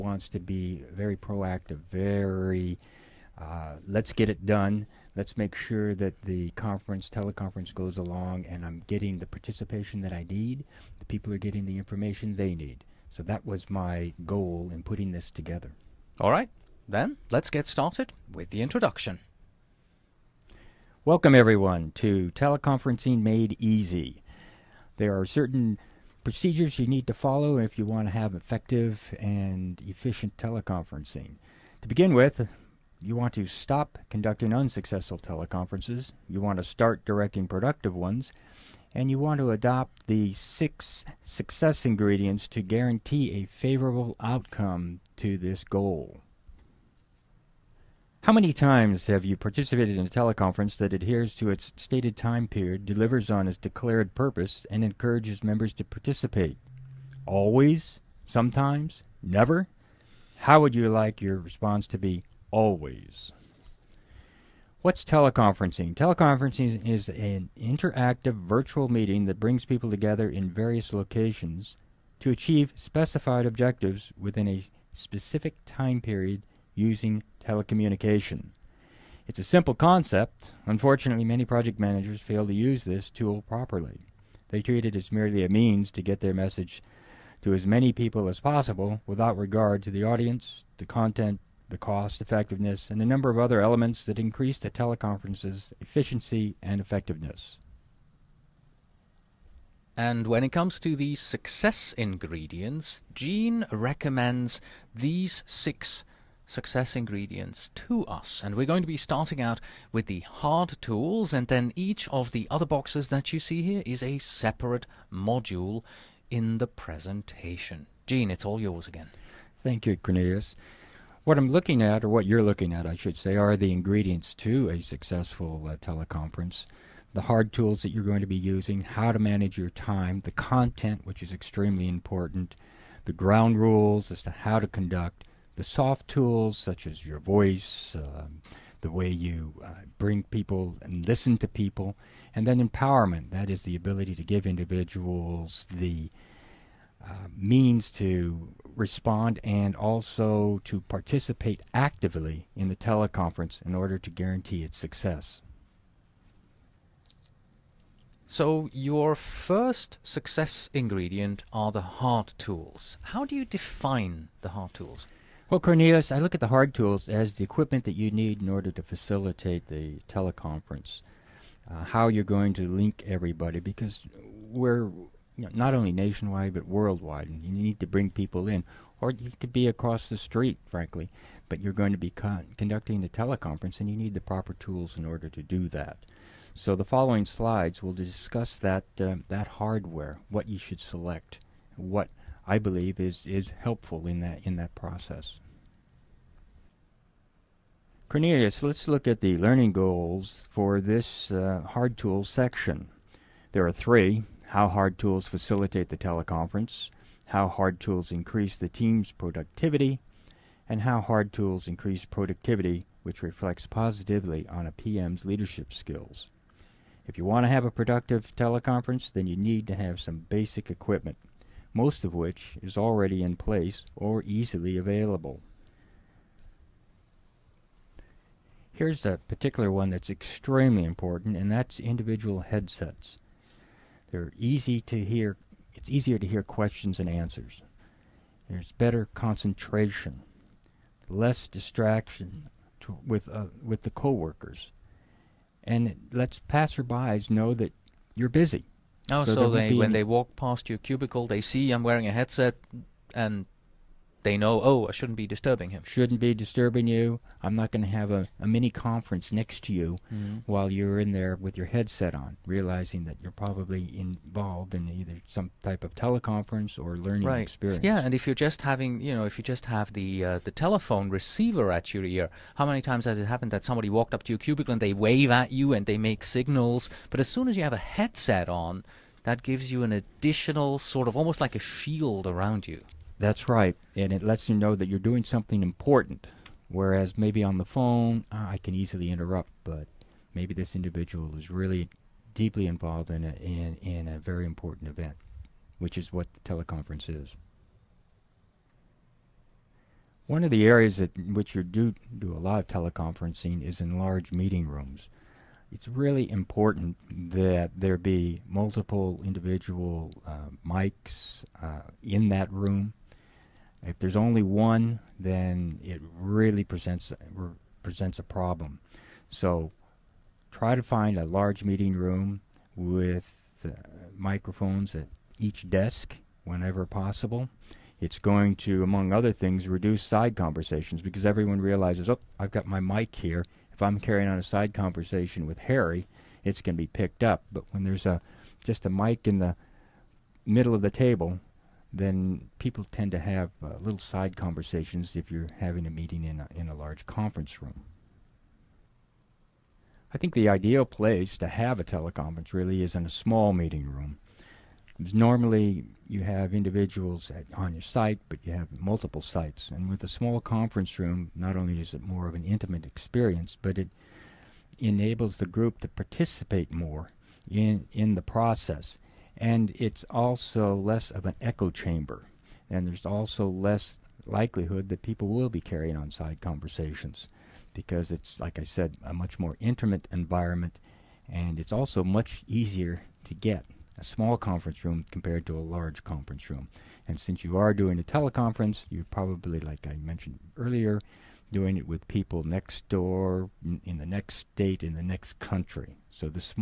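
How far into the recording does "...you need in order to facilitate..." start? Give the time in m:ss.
2:47.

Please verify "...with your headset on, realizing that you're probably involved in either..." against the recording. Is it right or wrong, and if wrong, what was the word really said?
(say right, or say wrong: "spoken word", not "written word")
right.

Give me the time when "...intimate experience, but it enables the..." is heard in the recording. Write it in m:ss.
6:02.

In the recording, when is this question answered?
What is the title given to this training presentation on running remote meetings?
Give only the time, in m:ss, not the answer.
0:22.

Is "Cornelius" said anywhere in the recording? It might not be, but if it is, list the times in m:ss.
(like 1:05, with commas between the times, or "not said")
1:59, 2:45, 3:18.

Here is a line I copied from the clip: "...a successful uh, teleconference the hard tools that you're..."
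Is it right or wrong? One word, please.
right.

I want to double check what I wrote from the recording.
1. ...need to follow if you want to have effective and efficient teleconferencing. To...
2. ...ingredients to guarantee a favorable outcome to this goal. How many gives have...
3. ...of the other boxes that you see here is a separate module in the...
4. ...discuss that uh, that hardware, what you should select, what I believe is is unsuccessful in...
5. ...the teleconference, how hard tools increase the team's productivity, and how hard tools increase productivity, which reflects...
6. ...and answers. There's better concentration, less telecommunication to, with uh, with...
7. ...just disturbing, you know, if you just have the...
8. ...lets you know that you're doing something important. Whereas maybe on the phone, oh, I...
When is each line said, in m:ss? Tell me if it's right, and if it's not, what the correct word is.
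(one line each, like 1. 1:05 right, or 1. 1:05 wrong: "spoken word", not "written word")
1. 0:26 right
2. 0:41 wrong: "times", not "gives"
3. 1:52 right
4. 3:07 wrong: "helpful", not "unsuccessful"
5. 3:25 right
6. 3:56 wrong: "distraction", not "telecommunication"
7. 4:28 wrong: "having", not "disturbing"
8. 4:44 right.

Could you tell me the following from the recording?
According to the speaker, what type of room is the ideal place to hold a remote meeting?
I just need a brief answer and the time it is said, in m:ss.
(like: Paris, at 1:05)
A small meeting room, at 5:53.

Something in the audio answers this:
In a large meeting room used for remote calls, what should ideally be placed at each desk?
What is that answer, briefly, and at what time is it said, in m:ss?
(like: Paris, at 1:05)
Microphones, at 5:24.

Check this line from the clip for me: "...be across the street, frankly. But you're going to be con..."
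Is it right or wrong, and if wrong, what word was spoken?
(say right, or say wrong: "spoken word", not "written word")
right.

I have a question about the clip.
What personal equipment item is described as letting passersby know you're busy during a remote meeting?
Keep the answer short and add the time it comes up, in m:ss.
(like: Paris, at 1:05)
Individual headsets, at 3:51.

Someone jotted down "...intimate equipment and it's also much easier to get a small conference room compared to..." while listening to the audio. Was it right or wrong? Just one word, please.
wrong.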